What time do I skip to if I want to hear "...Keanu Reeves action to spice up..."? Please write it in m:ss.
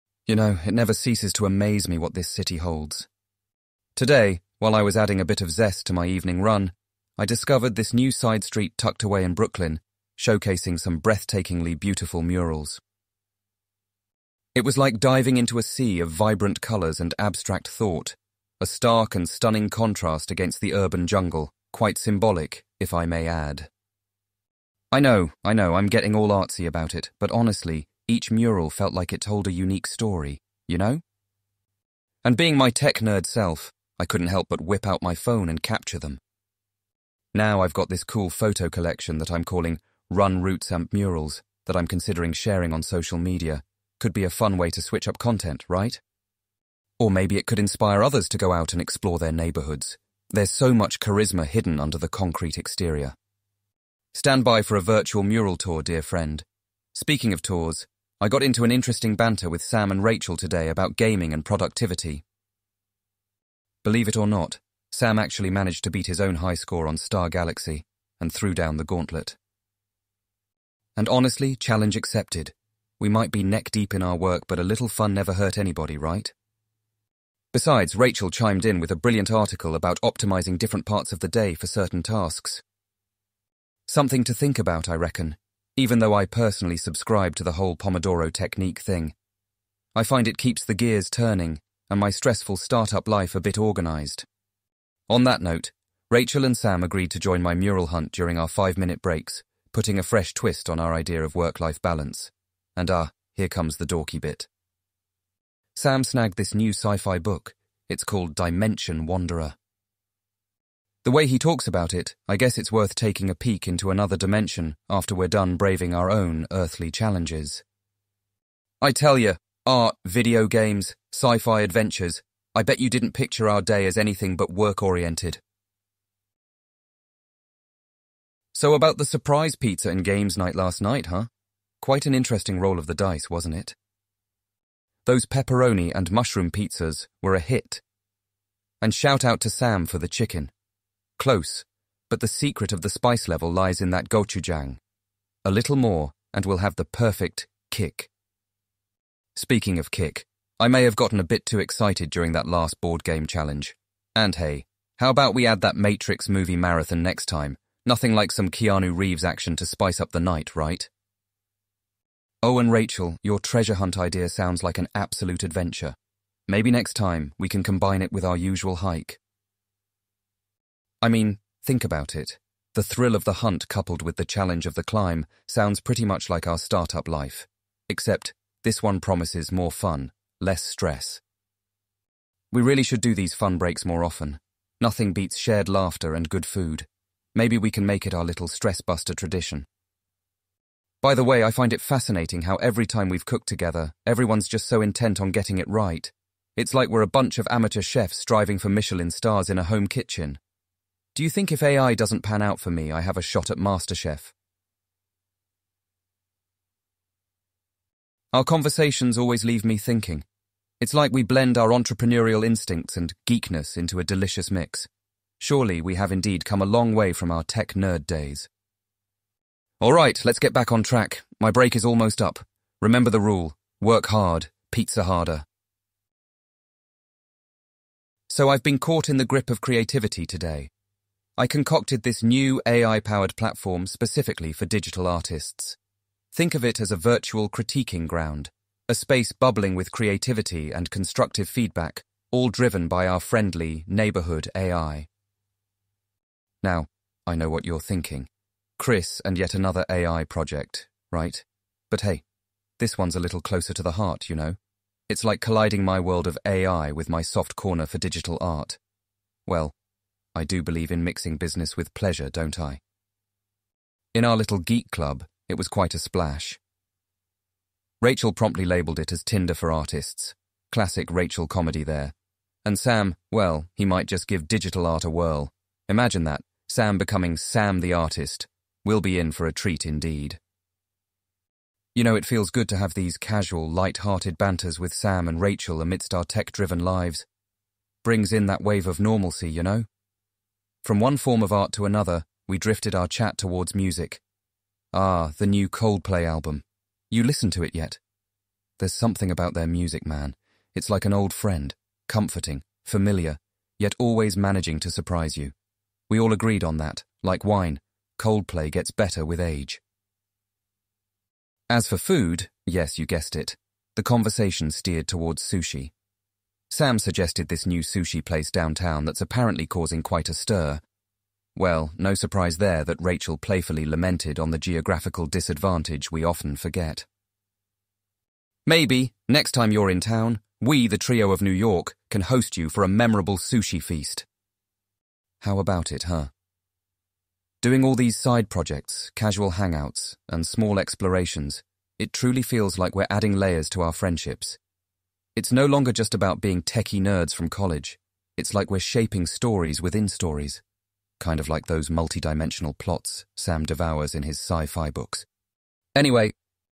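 2:38.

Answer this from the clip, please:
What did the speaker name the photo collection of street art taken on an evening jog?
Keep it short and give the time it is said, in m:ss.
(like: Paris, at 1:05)
Run Roots and Murals, at 0:40.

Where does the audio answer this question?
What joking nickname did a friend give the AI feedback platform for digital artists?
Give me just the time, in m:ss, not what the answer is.
4:29.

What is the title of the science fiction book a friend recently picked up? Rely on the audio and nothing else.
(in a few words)
Dimension Wanderer.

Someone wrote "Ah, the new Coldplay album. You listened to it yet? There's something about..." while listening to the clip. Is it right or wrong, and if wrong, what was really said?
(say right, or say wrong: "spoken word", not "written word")
right.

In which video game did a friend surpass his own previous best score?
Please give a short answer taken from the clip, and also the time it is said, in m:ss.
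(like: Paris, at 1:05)
Star Galaxy, at 1:06.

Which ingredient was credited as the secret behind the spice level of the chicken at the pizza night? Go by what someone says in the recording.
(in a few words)
Gochujang.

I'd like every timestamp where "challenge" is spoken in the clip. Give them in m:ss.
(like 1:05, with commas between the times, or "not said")
1:11, 1:56, 2:33, 2:54.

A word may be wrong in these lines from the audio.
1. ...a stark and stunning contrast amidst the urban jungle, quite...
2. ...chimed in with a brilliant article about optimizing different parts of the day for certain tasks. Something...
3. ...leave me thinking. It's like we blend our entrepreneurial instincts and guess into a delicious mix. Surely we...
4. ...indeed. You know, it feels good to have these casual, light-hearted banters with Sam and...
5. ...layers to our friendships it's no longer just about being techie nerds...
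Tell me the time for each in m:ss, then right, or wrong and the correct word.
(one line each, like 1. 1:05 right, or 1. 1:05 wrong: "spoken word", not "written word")
1. 0:18 wrong: "against", not "amidst"
2. 1:18 right
3. 3:29 wrong: "geekness", not "guess"
4. 4:39 right
5. 5:43 right.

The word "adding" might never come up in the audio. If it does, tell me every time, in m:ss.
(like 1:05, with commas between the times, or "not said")
0:04, 5:43.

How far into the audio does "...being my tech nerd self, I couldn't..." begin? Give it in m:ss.
0:32.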